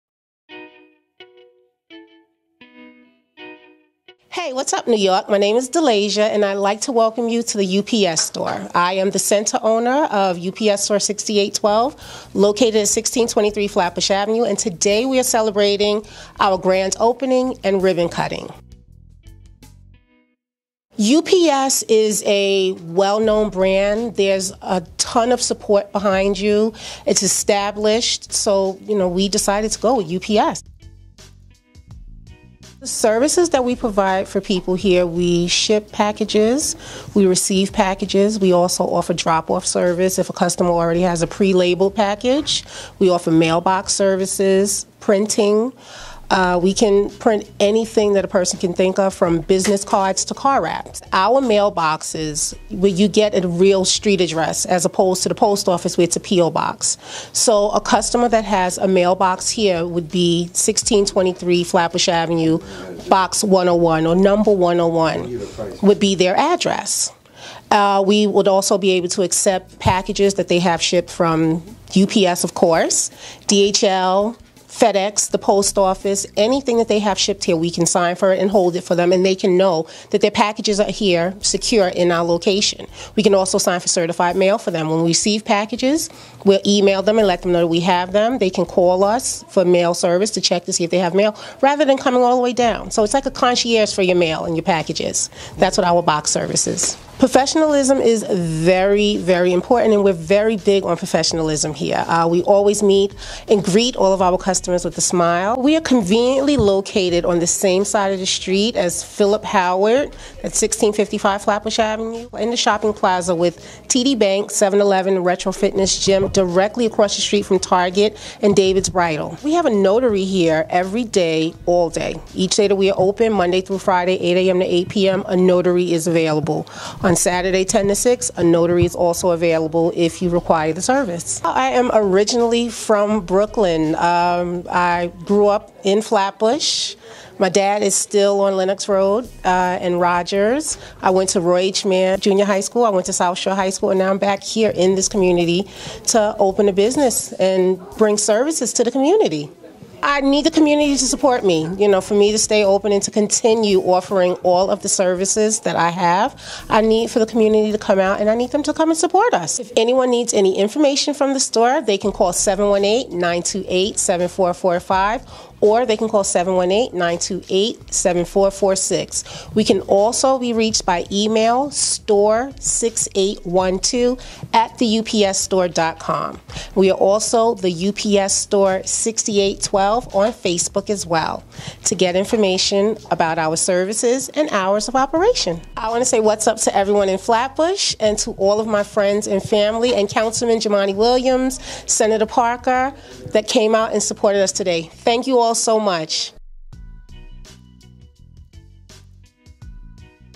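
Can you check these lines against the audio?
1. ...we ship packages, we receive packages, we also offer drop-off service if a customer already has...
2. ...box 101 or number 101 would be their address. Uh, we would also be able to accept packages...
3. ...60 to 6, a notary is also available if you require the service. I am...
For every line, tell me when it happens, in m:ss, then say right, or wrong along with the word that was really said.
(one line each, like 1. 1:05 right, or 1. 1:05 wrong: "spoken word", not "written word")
1. 0:35 right
2. 1:03 right
3. 2:07 wrong: "10", not "60".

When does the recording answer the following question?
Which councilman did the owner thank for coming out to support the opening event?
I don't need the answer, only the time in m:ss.
3:10.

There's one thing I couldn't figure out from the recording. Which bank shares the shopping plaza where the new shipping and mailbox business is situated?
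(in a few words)
TD Bank.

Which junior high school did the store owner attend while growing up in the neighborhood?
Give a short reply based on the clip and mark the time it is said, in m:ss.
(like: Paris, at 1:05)
Roy H. Mann Junior High School, at 2:21.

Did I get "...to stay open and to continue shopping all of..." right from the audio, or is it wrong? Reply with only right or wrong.
wrong.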